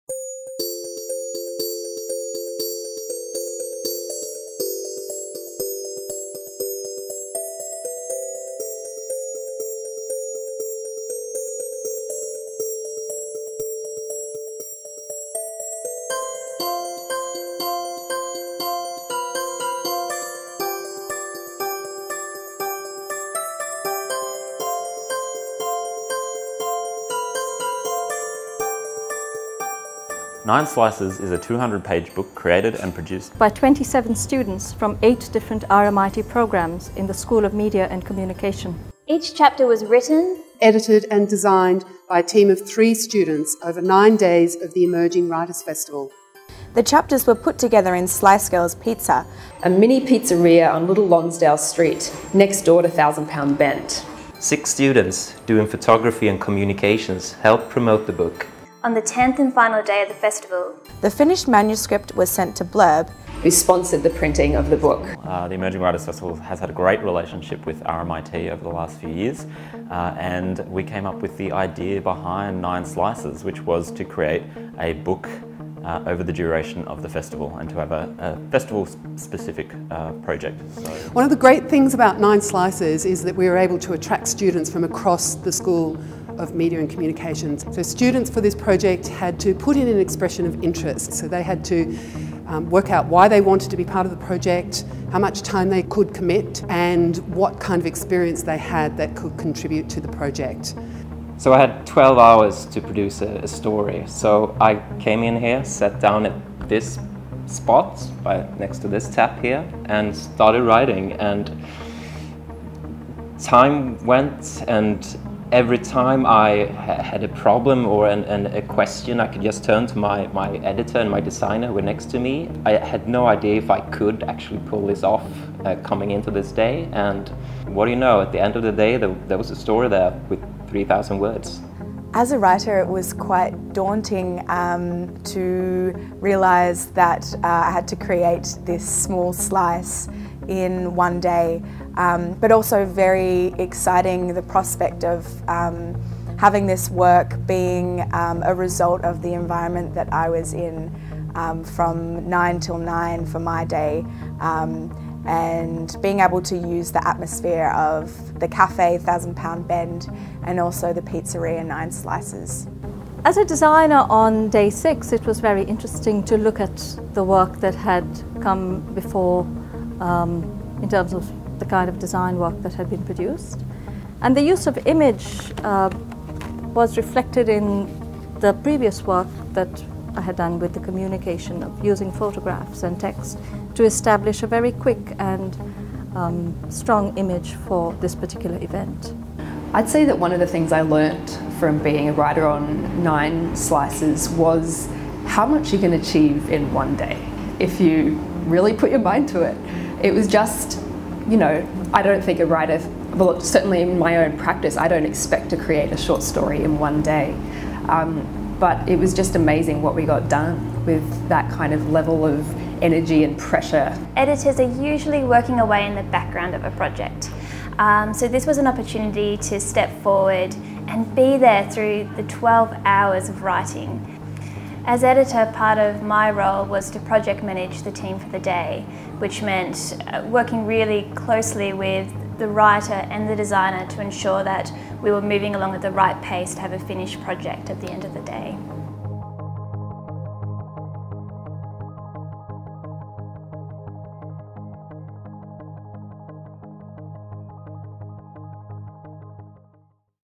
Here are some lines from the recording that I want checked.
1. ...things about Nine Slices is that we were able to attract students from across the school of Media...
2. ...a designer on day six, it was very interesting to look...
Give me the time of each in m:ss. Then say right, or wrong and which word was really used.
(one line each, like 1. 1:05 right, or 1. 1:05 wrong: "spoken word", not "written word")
1. 1:21 right
2. 2:43 right.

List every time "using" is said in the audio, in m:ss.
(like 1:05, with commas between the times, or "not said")
3:01.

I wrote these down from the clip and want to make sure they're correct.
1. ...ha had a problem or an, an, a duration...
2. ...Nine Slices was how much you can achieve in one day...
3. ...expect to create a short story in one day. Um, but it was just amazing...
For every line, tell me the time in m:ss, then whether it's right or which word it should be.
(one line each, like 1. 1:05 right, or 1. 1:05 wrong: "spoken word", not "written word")
1. 1:56 wrong: "question", not "duration"
2. 3:13 right
3. 3:25 right.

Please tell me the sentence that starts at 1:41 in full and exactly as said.
So I had 12 hours to produce a, a story.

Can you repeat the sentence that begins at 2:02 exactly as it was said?
I had no idea if I could actually pull this off uh, coming into this day.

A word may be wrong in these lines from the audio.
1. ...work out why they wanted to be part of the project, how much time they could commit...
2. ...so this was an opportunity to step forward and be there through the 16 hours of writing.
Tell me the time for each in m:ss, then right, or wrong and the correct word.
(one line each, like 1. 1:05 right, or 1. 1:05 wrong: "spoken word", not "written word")
1. 1:32 right
2. 3:38 wrong: "12", not "16".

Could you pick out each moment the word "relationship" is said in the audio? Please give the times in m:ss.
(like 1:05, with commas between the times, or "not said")
1:07.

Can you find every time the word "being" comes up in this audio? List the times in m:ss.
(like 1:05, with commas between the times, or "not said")
2:27, 2:36, 3:11.